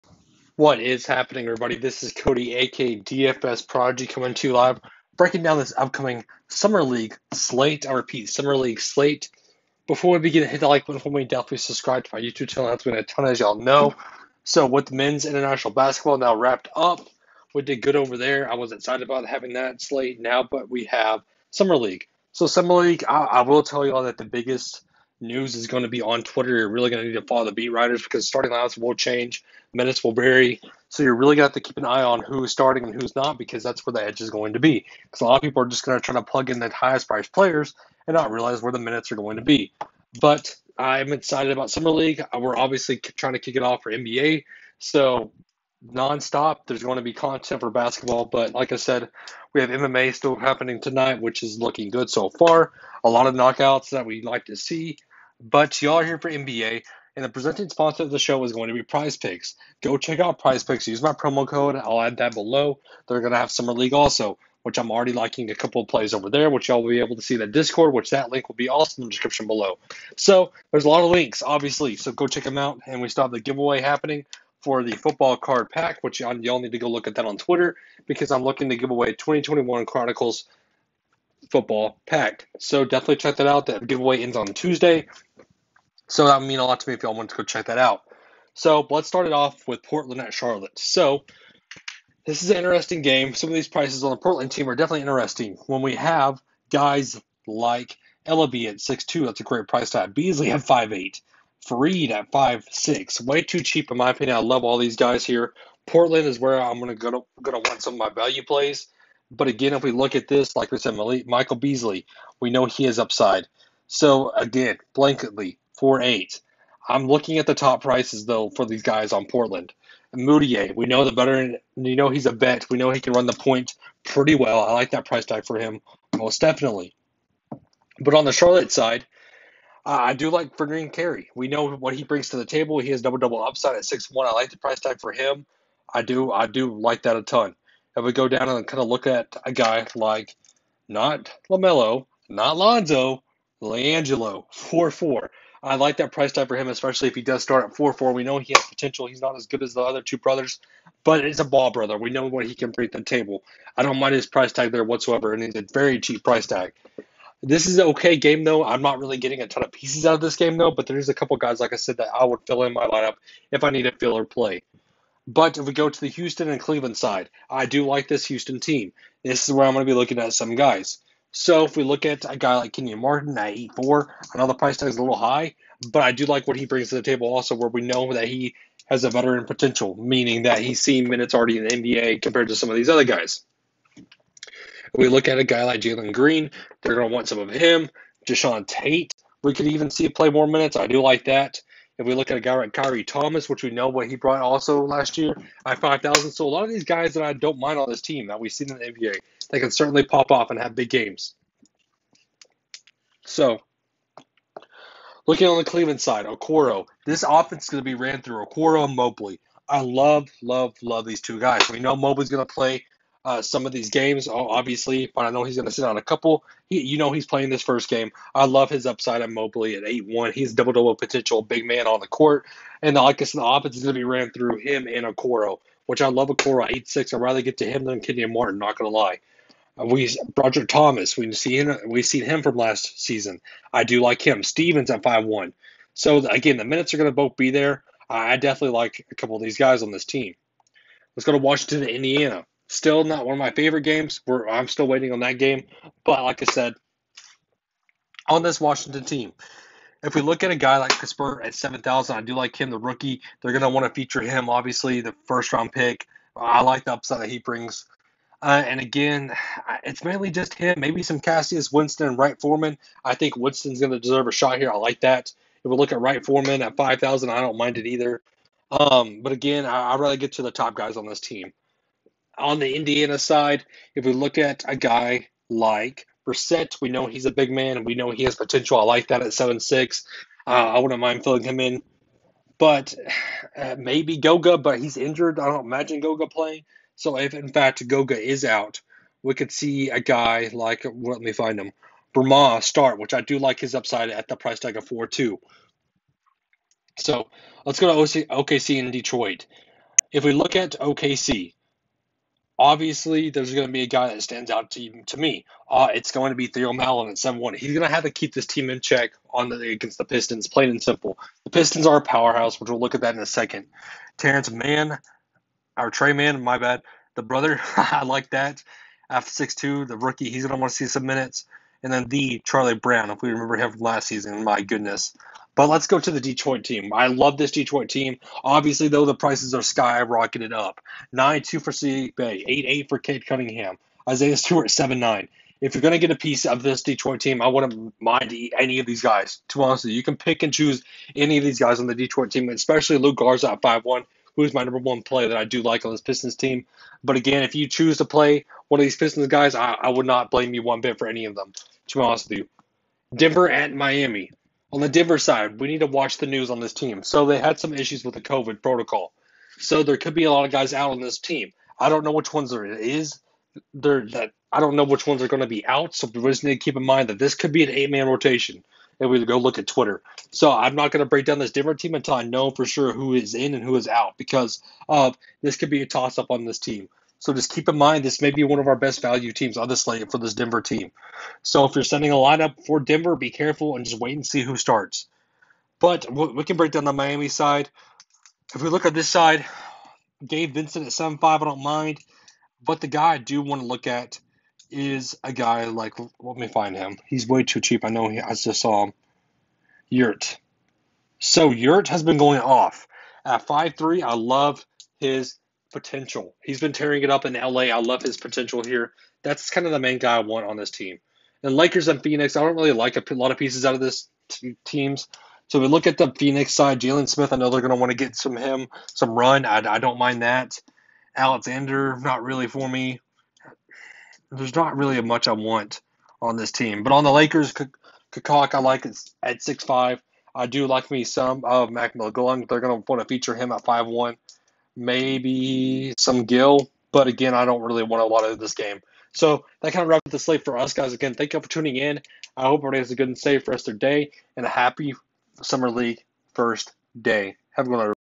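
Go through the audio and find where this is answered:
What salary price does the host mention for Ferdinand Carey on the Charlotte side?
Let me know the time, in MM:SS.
02:13.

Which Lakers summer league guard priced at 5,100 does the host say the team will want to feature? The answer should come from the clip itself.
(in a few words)
Mac McClung.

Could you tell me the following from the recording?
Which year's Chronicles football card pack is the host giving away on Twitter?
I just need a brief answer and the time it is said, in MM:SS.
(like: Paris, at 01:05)
2021, at 01:19.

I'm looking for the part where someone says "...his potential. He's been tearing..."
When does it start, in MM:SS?
06:44.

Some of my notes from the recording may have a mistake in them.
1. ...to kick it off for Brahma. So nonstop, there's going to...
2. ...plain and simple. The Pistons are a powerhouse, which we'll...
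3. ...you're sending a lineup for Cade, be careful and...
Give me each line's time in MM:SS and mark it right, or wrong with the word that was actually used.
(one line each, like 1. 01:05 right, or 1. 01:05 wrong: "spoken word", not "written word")
1. 00:43 wrong: "NBA", not "Brahma"
2. 05:10 right
3. 06:21 wrong: "Denver", not "Cade".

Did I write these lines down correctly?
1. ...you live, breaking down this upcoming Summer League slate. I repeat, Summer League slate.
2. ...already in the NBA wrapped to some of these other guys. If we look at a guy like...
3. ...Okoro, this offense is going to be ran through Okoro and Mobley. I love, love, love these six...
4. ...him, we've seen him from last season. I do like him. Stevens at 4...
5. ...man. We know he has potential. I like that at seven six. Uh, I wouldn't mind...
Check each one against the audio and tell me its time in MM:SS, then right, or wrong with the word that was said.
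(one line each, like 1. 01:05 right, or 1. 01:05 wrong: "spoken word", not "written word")
1. 00:04 right
2. 03:01 wrong: "compared", not "wrapped"
3. 03:26 wrong: "two", not "six"
4. 03:51 wrong: "5", not "4"
5. 04:37 right.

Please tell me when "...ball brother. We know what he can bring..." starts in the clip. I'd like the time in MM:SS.
02:31.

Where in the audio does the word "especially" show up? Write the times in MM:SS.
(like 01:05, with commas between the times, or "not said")
02:26, 05:42.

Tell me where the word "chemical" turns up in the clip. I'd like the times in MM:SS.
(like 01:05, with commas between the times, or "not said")
not said.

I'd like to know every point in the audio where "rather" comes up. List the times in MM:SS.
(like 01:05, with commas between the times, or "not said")
03:47, 04:29.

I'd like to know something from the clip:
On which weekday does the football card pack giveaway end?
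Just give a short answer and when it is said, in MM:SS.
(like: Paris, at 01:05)
Tuesday, at 01:24.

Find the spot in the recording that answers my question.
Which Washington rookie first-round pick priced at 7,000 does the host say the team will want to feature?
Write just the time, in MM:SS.
04:10.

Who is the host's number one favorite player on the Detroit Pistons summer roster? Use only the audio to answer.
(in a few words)
Luka Garza.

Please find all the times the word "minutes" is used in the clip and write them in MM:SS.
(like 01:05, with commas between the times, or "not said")
00:29, 00:38, 03:01, 03:10, 03:56, 05:21.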